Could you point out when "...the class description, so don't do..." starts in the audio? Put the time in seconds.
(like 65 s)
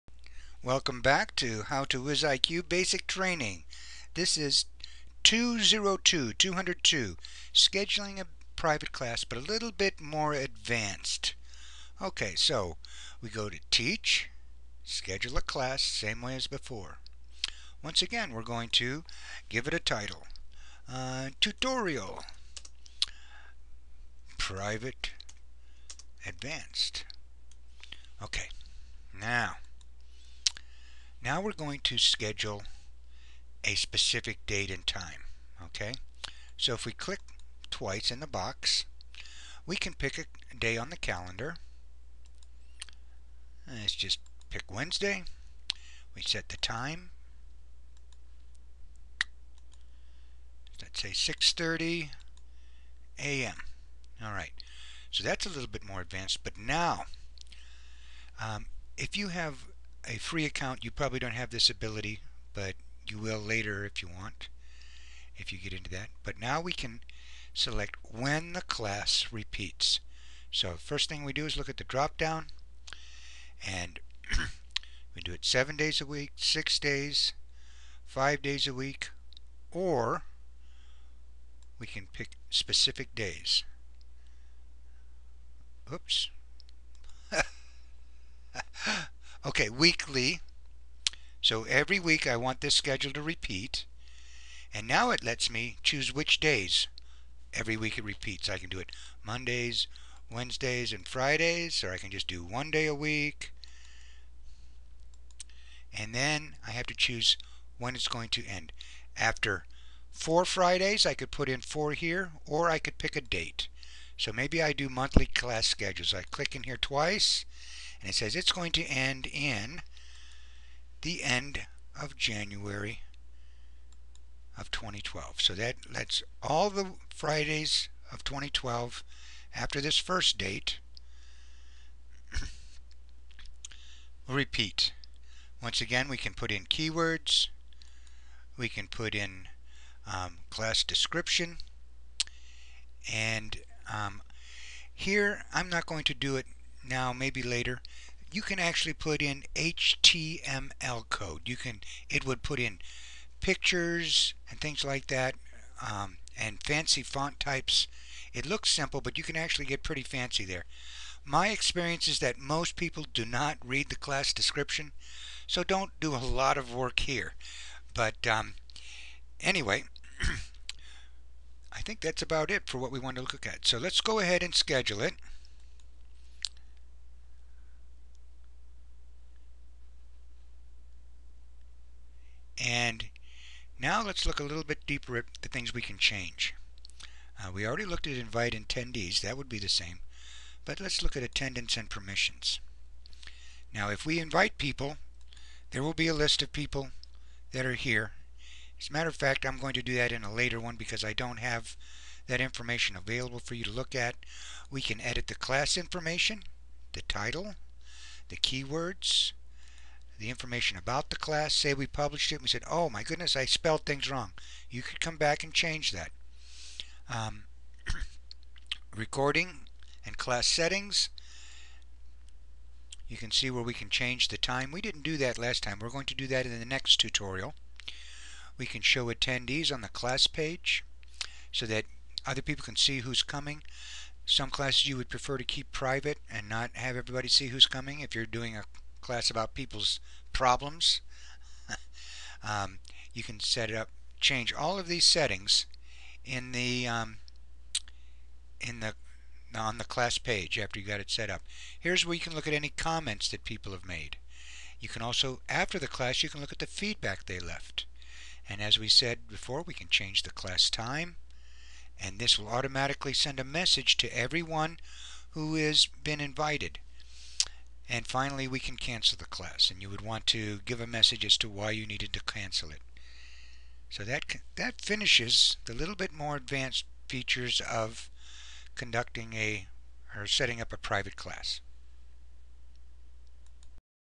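163 s.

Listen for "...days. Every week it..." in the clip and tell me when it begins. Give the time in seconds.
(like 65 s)
96 s.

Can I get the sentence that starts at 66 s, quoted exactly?
But now we can select when the class repeats.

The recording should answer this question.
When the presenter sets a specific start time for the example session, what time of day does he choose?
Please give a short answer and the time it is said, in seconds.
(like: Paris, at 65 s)
6:30 a.m., at 51 s.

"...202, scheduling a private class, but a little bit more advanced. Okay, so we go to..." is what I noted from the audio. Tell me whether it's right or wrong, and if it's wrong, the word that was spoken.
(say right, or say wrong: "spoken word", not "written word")
right.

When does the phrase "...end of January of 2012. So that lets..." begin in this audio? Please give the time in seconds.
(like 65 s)
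121 s.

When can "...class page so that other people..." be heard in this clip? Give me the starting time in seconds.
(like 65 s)
229 s.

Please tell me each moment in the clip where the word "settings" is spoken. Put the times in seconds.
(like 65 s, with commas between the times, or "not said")
220 s, 245 s, 280 s.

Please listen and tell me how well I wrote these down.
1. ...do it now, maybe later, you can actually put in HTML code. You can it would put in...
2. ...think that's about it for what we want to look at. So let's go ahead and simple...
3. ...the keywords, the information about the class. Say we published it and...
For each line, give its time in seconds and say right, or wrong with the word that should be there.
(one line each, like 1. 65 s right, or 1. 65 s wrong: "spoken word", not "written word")
1. 146 s right
2. 171 s wrong: "schedule", not "simple"
3. 208 s right.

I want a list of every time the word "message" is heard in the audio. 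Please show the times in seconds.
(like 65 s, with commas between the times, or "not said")
263 s, 270 s.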